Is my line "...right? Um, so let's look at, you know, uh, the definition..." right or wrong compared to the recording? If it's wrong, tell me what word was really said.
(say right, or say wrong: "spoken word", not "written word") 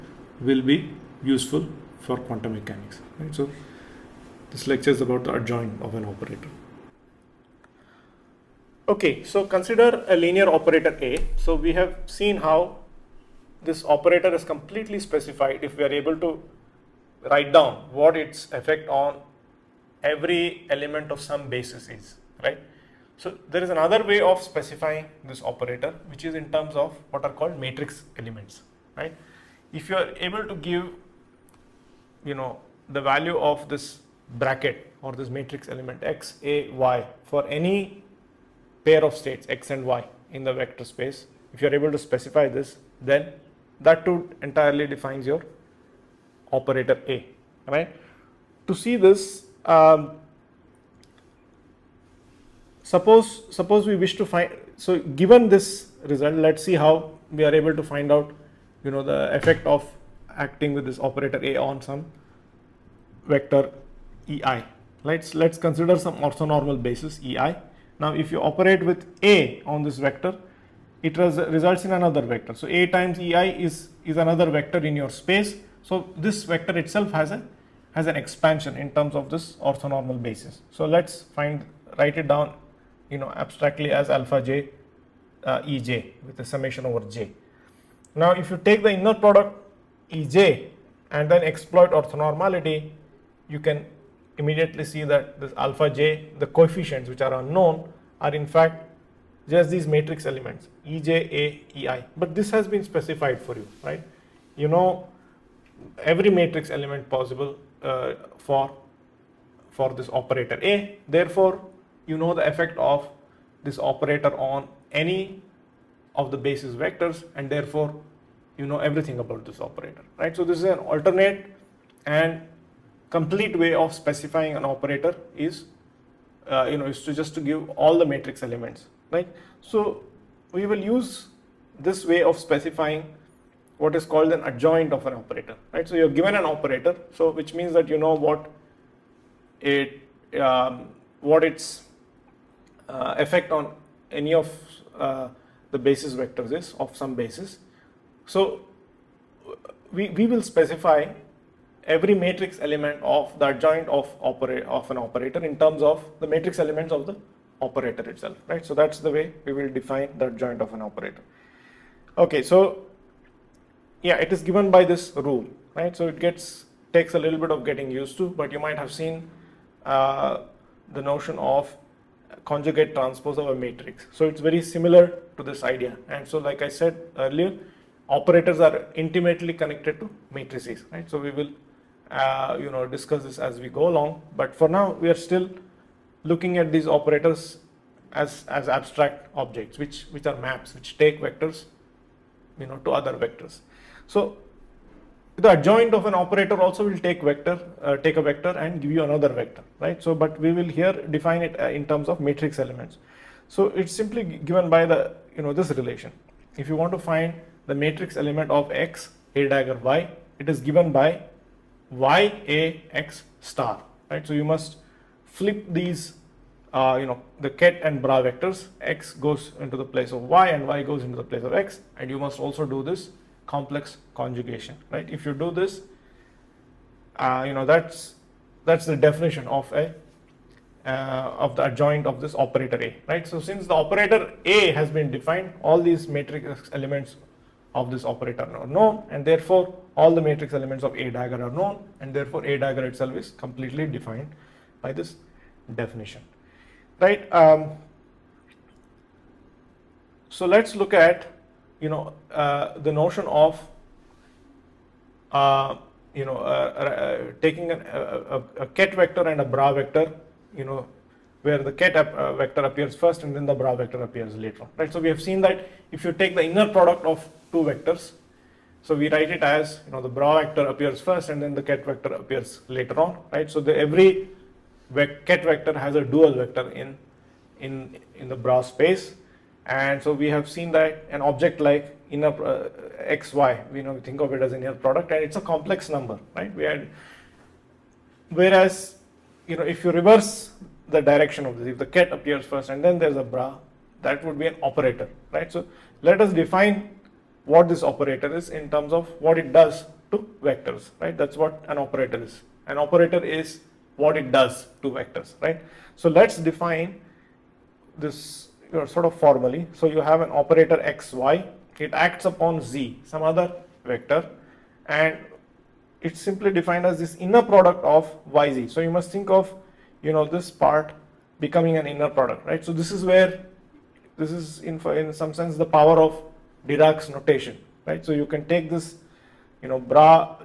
wrong: "notion", not "definition".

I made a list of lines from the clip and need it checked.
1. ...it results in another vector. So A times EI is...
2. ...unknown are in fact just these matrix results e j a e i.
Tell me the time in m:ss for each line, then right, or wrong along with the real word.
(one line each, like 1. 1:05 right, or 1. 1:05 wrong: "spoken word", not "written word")
1. 1:11 right
2. 1:37 wrong: "elements", not "results".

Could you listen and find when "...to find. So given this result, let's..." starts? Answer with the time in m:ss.
0:54.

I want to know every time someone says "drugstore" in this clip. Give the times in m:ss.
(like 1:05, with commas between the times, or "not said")
not said.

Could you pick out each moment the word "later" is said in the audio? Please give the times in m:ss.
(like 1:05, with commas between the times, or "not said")
4:24, 4:32.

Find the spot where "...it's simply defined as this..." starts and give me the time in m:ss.
5:16.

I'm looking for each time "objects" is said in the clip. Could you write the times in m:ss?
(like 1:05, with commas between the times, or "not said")
3:09, 4:41.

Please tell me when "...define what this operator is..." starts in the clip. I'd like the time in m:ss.
4:56.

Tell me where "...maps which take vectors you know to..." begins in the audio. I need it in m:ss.
3:10.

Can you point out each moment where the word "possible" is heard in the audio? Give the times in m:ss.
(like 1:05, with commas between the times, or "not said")
1:47.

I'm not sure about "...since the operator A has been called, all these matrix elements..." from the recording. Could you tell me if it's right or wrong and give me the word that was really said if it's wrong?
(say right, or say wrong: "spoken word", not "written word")
wrong: "defined", not "called".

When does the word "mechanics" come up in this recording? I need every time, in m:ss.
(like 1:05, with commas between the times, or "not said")
0:02.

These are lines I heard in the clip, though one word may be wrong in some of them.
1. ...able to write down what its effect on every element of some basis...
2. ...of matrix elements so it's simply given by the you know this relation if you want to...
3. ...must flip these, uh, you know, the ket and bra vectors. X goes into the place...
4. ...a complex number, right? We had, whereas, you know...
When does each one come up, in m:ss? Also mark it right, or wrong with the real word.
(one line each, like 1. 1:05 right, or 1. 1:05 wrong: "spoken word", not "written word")
1. 0:15 right
2. 3:22 right
3. 3:34 right
4. 4:45 right.